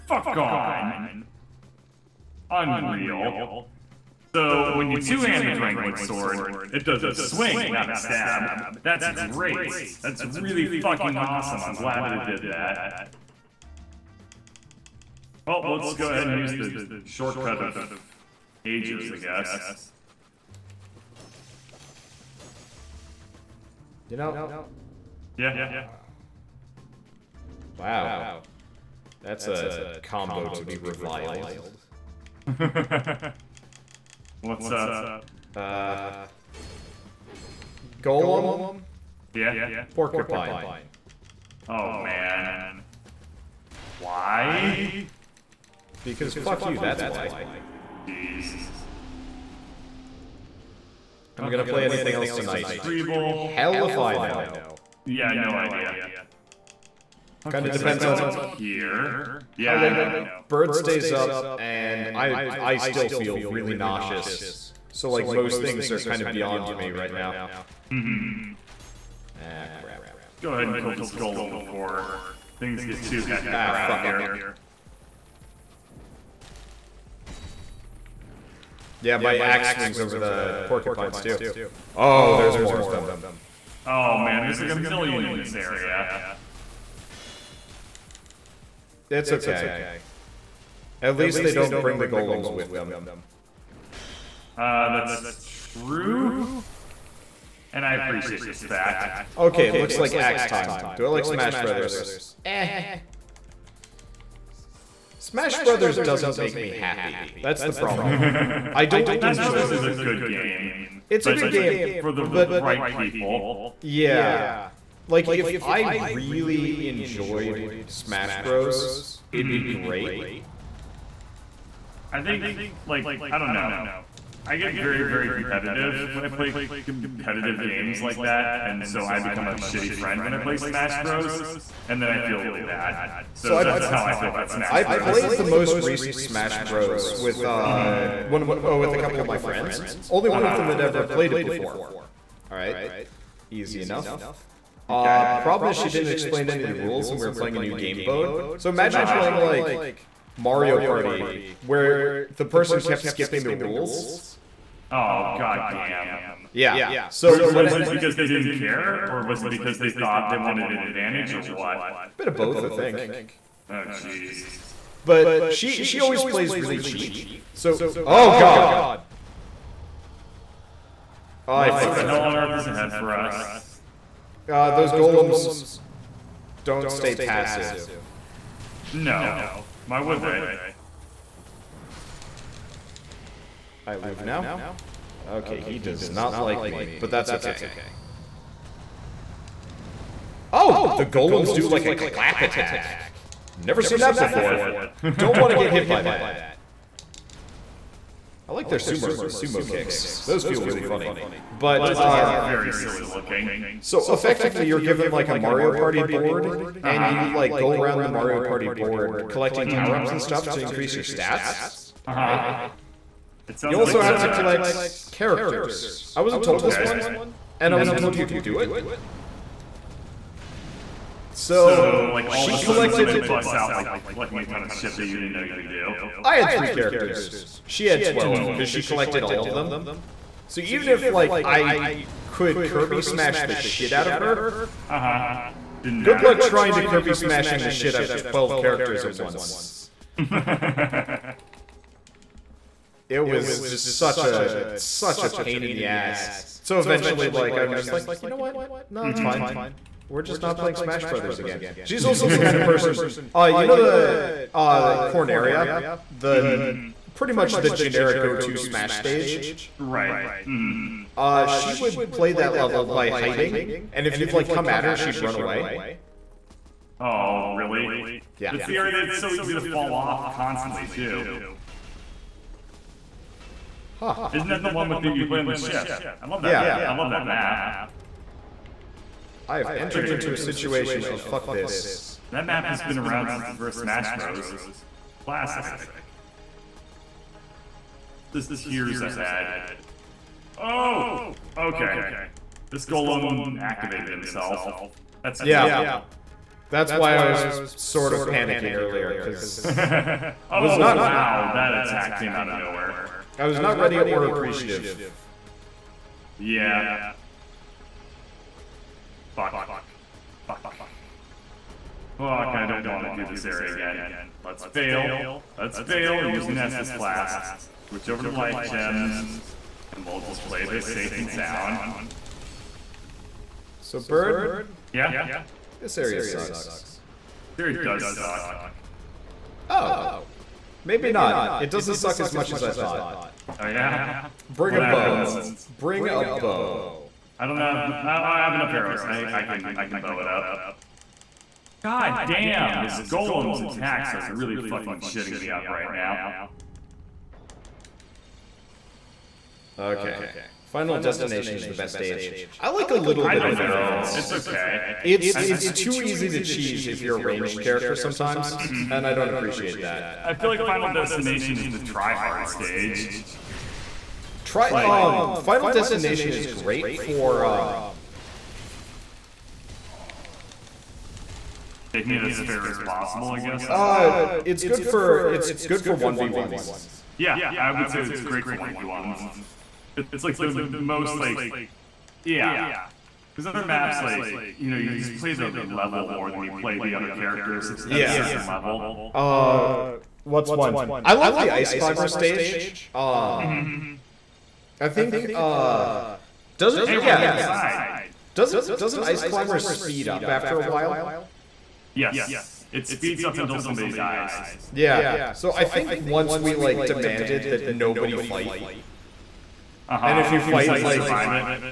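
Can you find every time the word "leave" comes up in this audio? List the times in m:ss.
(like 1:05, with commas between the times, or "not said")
3:03.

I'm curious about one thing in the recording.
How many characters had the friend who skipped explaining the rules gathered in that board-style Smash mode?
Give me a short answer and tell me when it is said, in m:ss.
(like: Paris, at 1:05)
12, at 3:47.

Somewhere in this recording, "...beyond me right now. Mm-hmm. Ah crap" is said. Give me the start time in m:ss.
1:06.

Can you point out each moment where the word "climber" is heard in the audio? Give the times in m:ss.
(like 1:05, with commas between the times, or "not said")
6:31, 6:39.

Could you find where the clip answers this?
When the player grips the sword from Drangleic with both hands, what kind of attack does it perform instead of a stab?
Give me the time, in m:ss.
0:06.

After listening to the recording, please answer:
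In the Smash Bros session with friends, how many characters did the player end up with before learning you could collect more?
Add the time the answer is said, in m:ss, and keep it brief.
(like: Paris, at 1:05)
3, at 3:46.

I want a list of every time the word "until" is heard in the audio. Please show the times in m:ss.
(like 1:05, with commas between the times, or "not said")
6:43.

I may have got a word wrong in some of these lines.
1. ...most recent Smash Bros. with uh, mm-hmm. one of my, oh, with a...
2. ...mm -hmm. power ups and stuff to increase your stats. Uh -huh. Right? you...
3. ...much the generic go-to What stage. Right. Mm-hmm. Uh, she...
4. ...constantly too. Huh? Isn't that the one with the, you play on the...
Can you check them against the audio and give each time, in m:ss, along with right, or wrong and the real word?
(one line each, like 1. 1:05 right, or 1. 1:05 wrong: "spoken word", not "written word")
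1. 2:15 right
2. 3:29 right
3. 4:17 wrong: "Smash", not "What"
4. 4:30 right.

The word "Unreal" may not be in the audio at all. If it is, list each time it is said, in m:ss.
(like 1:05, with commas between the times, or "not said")
0:02.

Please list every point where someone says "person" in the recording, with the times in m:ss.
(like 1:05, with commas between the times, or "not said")
2:32, 4:12.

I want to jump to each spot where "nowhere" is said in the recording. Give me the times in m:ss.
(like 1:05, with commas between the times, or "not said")
5:02.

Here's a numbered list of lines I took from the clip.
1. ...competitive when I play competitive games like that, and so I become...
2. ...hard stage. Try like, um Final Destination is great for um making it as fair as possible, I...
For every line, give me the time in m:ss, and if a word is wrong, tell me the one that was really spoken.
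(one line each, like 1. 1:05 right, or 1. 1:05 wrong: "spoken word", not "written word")
1. 2:05 right
2. 6:02 right.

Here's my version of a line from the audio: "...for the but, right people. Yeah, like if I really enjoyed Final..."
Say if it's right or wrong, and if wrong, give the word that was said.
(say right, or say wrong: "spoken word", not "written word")
wrong: "Smash", not "Final".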